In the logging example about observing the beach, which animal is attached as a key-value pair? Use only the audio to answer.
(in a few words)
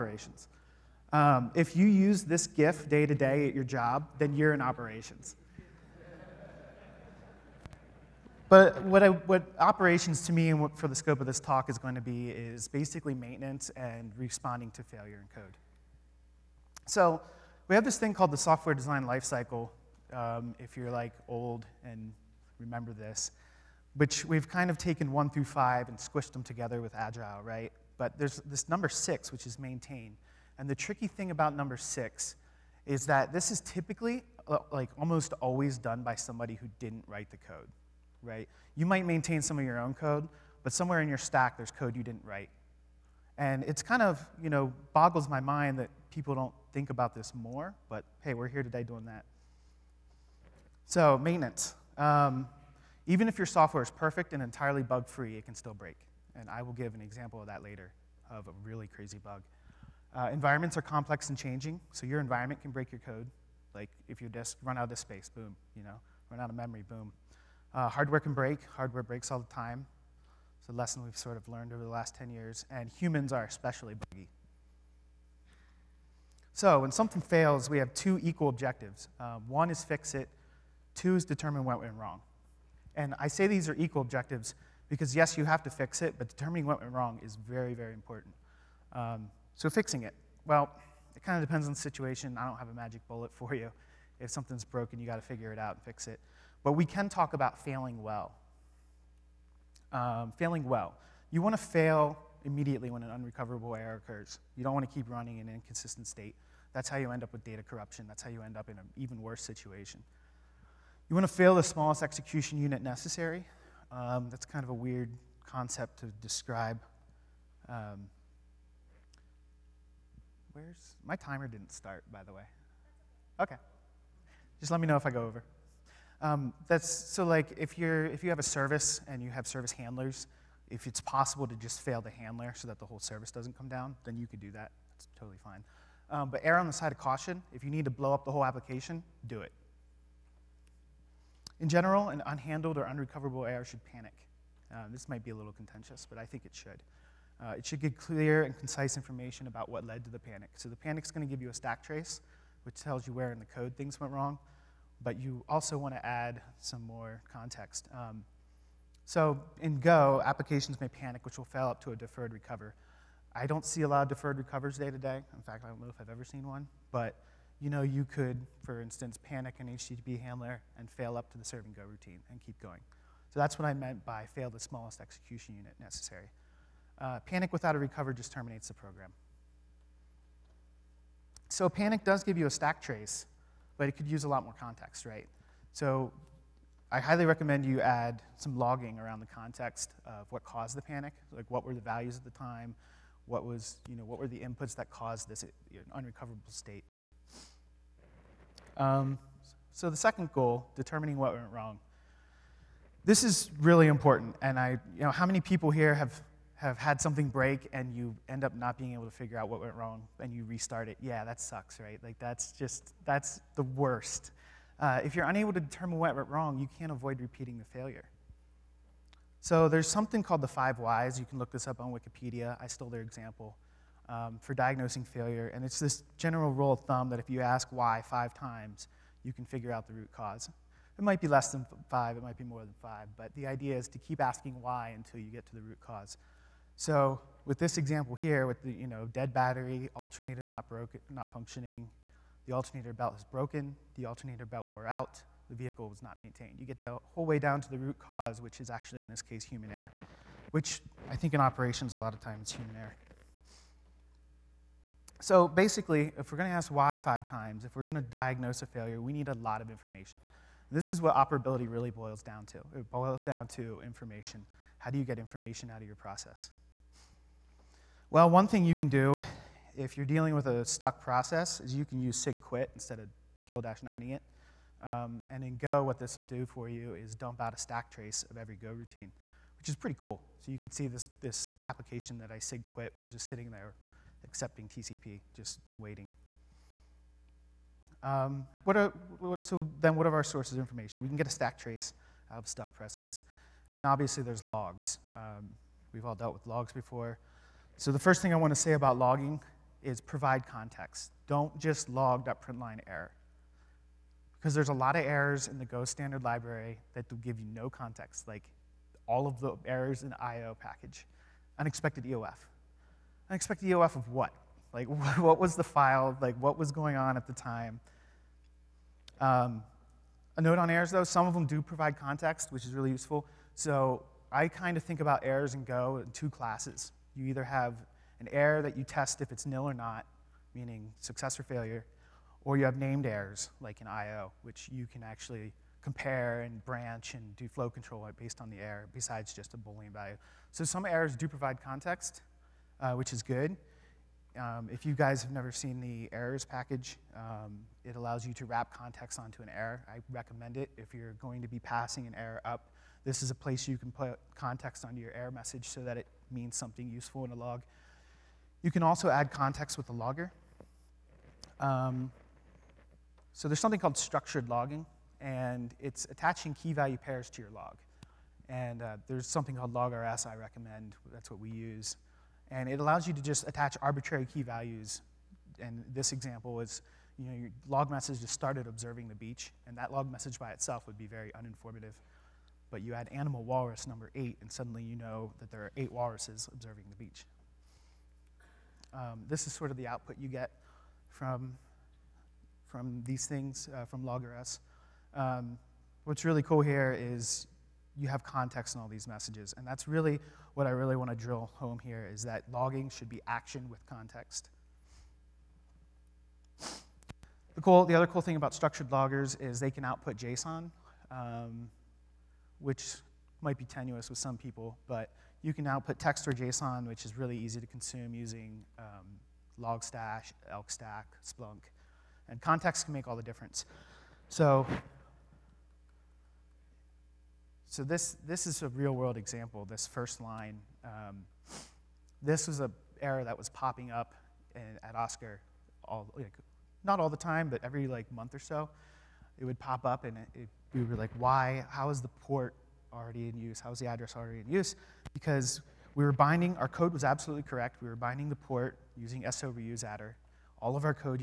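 walrus.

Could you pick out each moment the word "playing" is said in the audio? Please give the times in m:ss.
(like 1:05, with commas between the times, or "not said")
not said.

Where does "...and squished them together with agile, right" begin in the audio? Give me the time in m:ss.
0:25.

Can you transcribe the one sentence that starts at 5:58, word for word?
You can also add context with the logger.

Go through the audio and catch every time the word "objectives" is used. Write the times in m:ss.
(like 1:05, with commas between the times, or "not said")
1:18, 1:24.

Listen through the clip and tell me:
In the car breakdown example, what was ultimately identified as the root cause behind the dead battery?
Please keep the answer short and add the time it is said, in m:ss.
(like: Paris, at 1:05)
vehicle was not maintained, at 4:05.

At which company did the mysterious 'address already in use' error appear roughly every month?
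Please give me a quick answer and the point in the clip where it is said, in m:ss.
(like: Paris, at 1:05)
Oscar, at 7:14.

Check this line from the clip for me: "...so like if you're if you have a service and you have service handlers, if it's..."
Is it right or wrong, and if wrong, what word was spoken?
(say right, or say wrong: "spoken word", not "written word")
right.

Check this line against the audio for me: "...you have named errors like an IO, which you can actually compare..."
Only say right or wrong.
right.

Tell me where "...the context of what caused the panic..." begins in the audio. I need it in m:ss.
3:09.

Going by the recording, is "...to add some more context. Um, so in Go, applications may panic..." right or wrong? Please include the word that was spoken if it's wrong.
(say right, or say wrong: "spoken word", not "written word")
right.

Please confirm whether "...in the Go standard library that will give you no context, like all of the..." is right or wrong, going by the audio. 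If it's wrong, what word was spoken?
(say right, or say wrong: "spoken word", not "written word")
right.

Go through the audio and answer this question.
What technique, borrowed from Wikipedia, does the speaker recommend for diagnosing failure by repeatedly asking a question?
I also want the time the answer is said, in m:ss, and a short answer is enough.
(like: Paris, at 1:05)
the five whys, at 3:40.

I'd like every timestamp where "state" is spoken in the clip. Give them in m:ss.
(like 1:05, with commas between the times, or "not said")
1:46, 3:16.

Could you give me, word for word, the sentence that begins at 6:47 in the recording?
The, cool, the other cool thing about structured loggers is they can output JSON.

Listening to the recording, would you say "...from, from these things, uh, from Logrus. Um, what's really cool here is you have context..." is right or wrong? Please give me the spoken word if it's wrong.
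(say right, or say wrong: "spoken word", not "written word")
right.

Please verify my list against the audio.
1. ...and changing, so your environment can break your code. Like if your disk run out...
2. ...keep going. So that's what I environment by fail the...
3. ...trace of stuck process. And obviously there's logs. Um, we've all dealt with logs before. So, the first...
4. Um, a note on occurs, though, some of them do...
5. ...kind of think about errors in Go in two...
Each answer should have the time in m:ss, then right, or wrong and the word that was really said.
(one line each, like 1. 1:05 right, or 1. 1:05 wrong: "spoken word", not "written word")
1. 1:01 right
2. 2:52 wrong: "meant", not "environment"
3. 4:51 right
4. 5:19 wrong: "errors", not "occurs"
5. 5:24 right.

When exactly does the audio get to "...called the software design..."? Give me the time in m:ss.
0:18.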